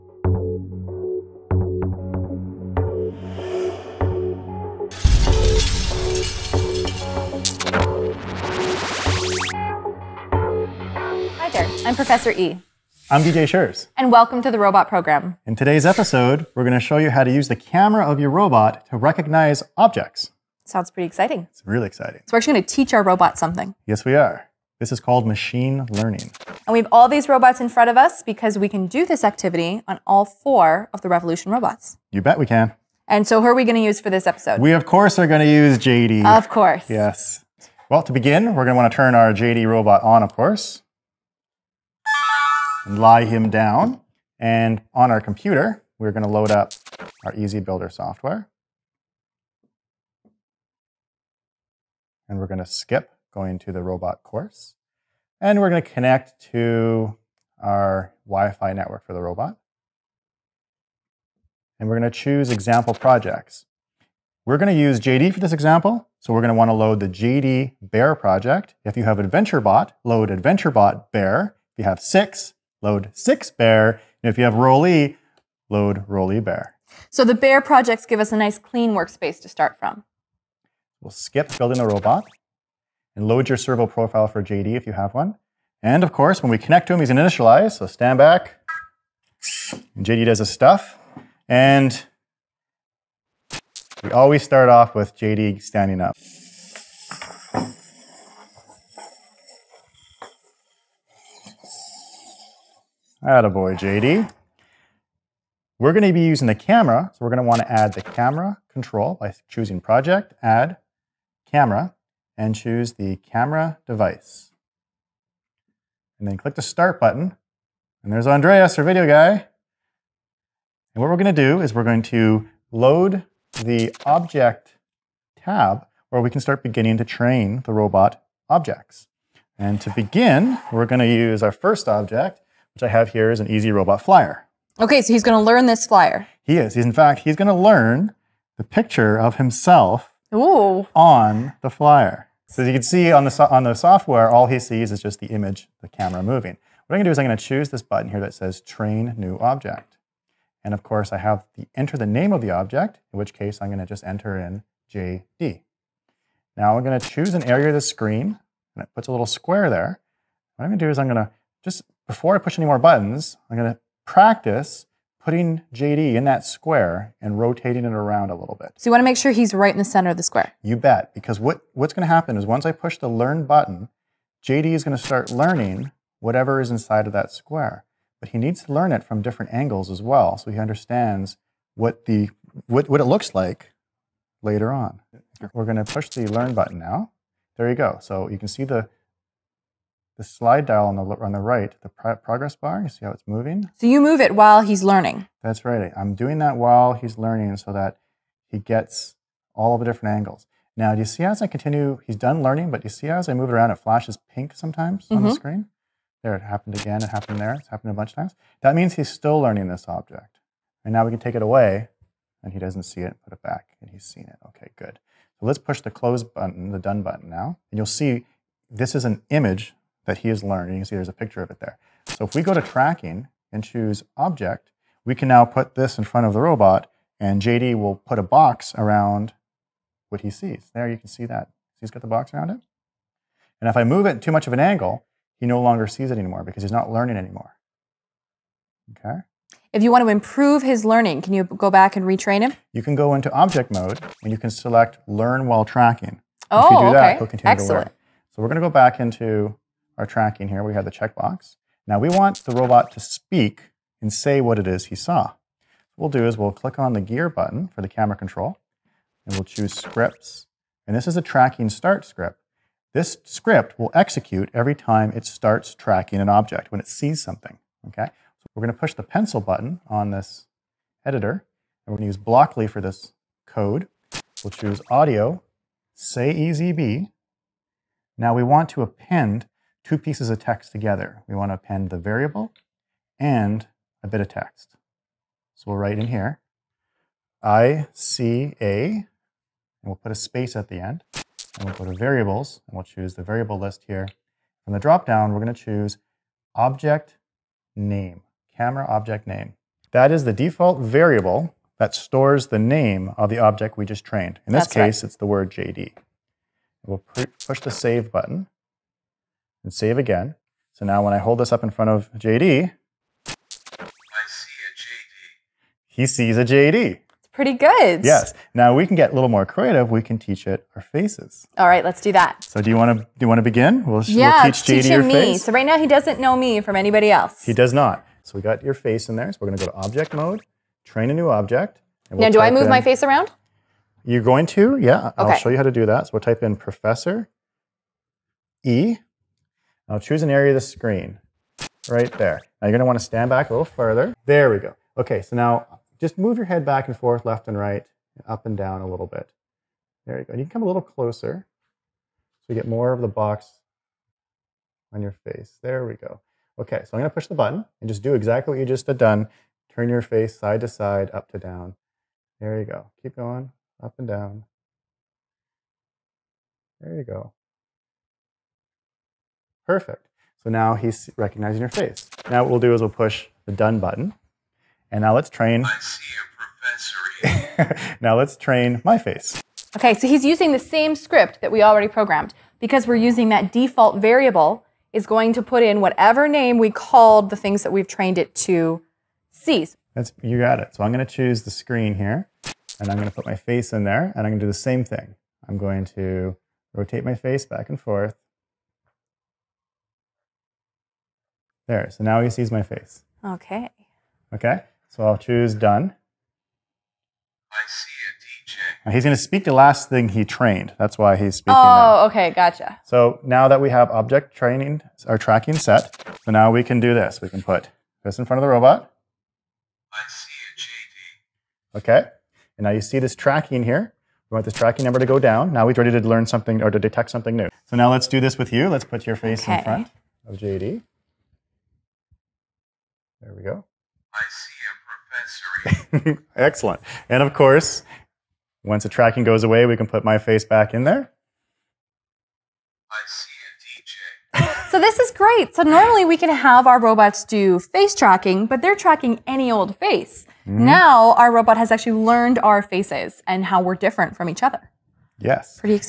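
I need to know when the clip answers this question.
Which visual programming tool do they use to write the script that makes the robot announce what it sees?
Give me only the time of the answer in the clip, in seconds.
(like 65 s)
272 s.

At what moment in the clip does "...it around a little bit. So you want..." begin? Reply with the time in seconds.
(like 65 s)
167 s.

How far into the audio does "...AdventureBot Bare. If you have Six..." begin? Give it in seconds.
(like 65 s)
70 s.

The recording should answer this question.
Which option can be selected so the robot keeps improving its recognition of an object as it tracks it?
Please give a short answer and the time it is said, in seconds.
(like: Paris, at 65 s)
Learn while tracking, at 245 s.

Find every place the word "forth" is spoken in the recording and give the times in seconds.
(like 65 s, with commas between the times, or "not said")
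346 s, 397 s.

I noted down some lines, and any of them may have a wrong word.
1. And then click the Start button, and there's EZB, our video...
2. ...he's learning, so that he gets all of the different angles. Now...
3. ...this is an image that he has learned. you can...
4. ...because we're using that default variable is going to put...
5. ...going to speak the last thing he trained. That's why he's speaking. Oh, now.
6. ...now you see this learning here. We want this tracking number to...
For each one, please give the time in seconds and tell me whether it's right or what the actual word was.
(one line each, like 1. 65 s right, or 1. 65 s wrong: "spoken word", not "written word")
1. 116 s wrong: "Andreas", not "EZB"
2. 196 s right
3. 218 s right
4. 382 s right
5. 409 s right
6. 422 s wrong: "tracking", not "learning".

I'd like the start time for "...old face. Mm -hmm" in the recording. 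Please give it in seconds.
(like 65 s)
449 s.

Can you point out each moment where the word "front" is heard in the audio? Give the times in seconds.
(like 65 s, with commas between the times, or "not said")
27 s, 226 s, 311 s, 418 s, 429 s.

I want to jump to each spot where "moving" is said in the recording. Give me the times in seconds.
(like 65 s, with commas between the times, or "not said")
146 s, 193 s.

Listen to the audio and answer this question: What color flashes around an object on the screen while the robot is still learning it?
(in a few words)
Pink.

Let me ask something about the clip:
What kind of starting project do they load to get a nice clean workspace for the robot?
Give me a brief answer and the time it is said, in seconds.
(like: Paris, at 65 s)
Bare project, at 77 s.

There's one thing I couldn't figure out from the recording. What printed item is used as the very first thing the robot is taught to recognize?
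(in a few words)
EZ-Robot flyer.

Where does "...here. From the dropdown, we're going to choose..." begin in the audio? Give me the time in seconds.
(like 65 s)
293 s.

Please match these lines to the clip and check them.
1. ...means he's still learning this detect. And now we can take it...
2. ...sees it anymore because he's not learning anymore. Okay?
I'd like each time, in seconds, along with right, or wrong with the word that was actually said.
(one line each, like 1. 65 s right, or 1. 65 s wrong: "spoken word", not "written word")
1. 208 s wrong: "object", not "detect"
2. 235 s right.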